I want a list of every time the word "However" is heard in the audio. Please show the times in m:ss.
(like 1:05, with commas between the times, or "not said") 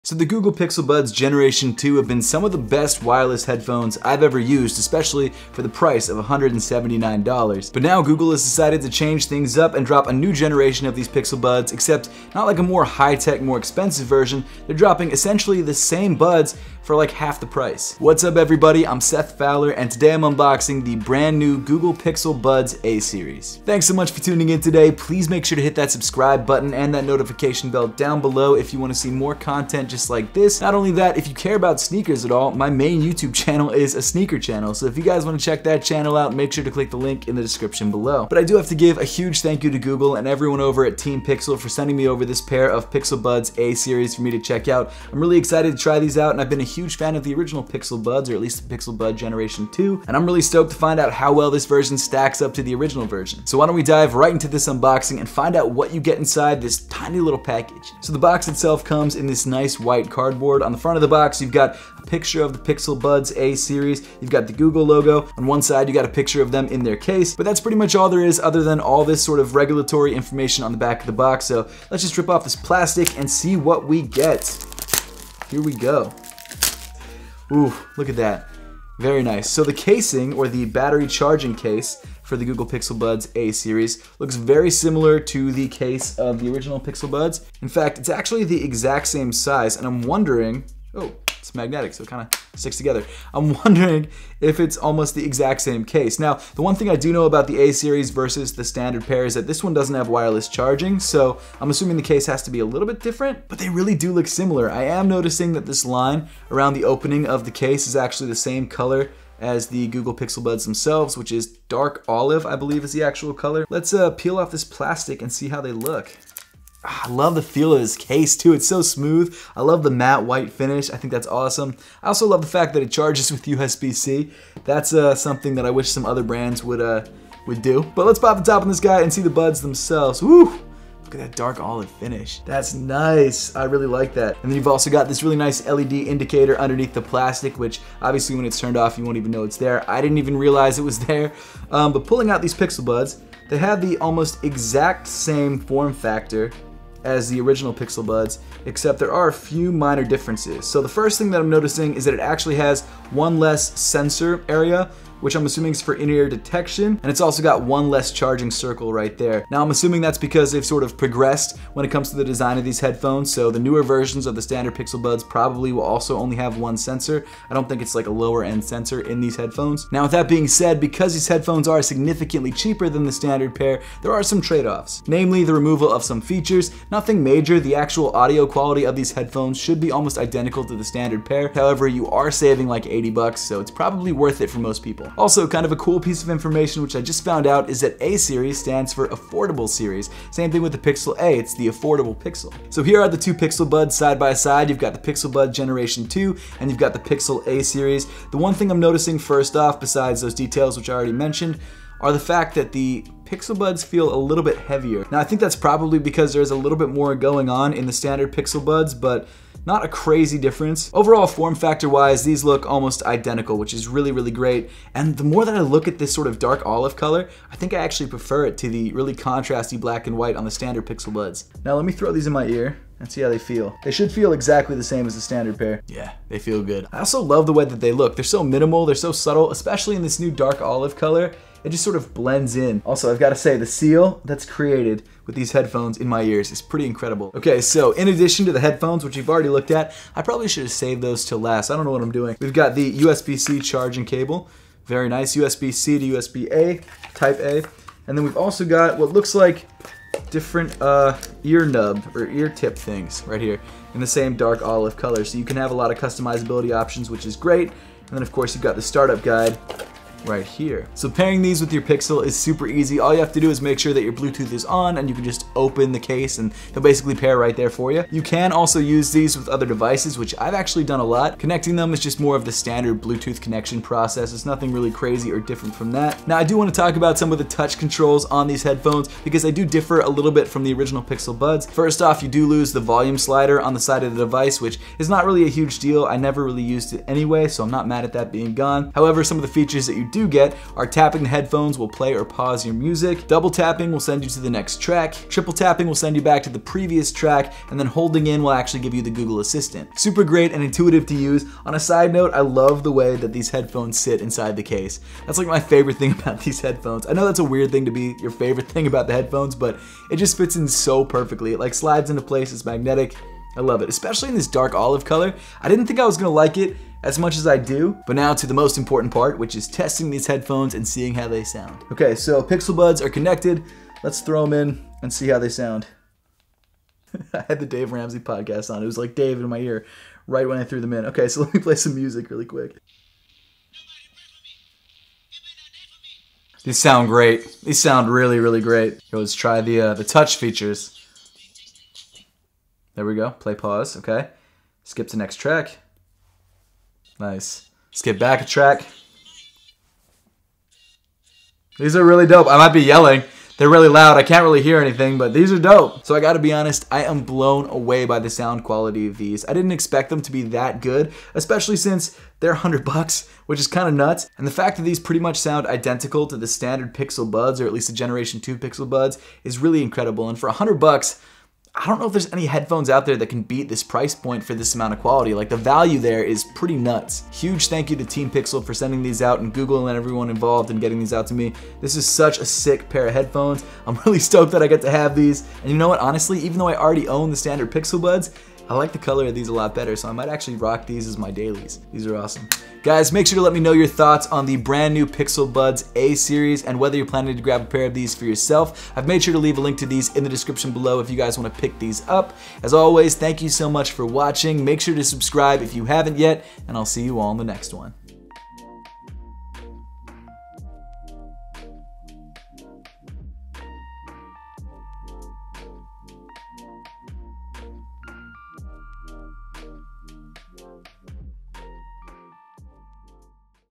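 3:01, 4:48.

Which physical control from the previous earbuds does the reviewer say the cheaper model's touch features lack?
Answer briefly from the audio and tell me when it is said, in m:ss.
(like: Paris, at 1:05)
Volume slider, at 4:42.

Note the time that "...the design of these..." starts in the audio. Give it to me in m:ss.
2:42.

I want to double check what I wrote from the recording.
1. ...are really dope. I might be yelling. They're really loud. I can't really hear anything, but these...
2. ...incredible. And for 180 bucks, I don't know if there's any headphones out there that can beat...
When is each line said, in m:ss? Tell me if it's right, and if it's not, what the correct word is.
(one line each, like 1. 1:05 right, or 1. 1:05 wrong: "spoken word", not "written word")
1. 5:51 right
2. 6:09 wrong: "100", not "180".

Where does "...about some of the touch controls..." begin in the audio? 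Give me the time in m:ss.
4:36.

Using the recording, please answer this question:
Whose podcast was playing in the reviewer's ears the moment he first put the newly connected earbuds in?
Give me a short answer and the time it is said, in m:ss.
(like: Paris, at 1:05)
Dave Ramsey, at 5:27.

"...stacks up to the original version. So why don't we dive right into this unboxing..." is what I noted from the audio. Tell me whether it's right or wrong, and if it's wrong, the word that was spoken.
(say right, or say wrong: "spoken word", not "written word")
right.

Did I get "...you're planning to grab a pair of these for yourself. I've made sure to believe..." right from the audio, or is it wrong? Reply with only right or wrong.
wrong.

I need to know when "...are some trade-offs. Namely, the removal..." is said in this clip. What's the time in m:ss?
2:54.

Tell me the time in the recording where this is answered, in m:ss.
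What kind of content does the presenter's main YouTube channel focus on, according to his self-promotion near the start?
0:34.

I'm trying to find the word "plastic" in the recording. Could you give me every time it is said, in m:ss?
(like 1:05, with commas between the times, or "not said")
1:12, 1:54, 2:17.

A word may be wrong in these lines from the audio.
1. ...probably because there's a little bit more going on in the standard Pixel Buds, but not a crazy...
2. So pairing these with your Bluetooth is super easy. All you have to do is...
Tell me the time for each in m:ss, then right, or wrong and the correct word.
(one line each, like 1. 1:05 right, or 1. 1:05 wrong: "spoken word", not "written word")
1. 3:25 right
2. 4:20 wrong: "Pixel", not "Bluetooth".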